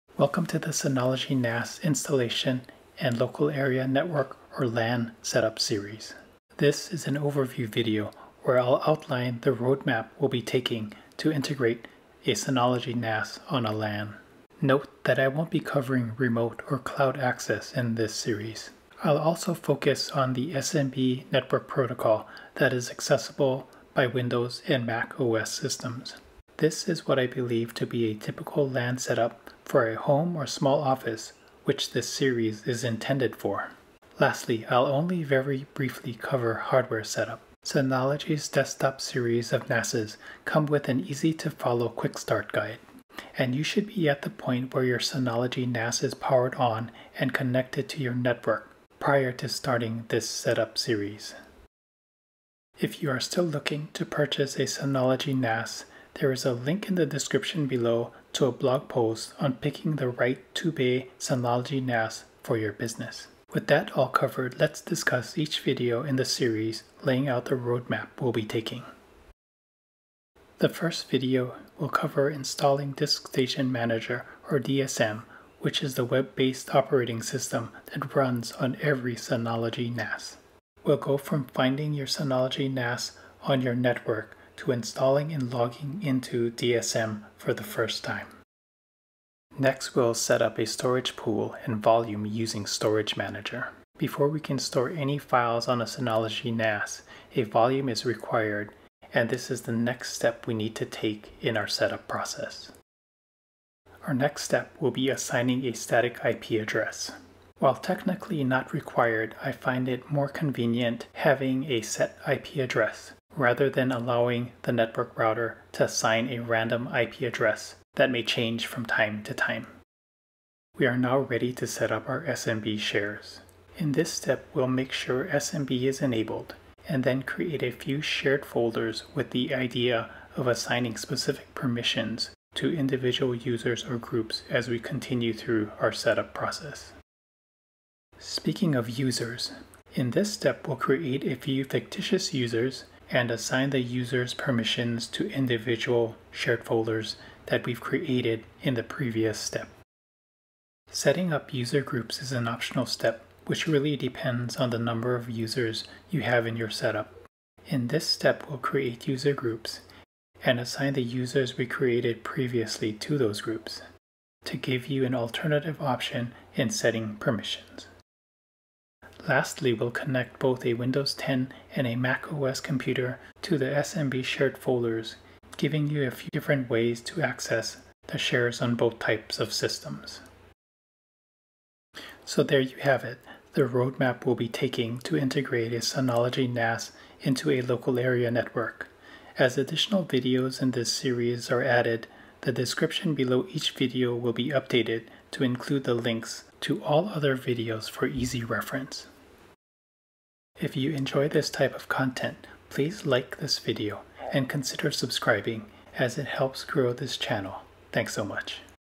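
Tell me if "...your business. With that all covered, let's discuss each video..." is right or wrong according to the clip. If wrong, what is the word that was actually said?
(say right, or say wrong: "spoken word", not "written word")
right.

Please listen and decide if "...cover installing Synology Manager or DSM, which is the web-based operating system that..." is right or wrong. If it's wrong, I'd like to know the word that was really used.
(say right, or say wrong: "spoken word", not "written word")
wrong: "DiskStation", not "Synology".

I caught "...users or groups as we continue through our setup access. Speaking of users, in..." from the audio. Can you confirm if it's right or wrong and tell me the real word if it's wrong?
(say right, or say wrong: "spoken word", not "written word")
wrong: "process", not "access".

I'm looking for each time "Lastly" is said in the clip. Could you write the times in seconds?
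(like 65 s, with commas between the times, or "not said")
34 s, 169 s.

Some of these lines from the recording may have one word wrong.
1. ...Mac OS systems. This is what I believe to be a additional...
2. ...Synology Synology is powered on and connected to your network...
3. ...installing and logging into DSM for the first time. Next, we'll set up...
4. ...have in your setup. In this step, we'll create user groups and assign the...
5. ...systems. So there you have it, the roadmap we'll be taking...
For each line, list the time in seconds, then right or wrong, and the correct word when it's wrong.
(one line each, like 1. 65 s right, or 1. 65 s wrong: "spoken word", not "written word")
1. 24 s wrong: "typical", not "additional"
2. 44 s wrong: "NAS", not "Synology"
3. 84 s right
4. 156 s right
5. 179 s right.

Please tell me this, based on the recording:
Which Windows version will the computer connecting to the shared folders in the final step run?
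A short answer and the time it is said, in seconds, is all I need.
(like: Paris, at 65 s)
Windows 10, at 170 s.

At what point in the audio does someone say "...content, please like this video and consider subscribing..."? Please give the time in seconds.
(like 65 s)
201 s.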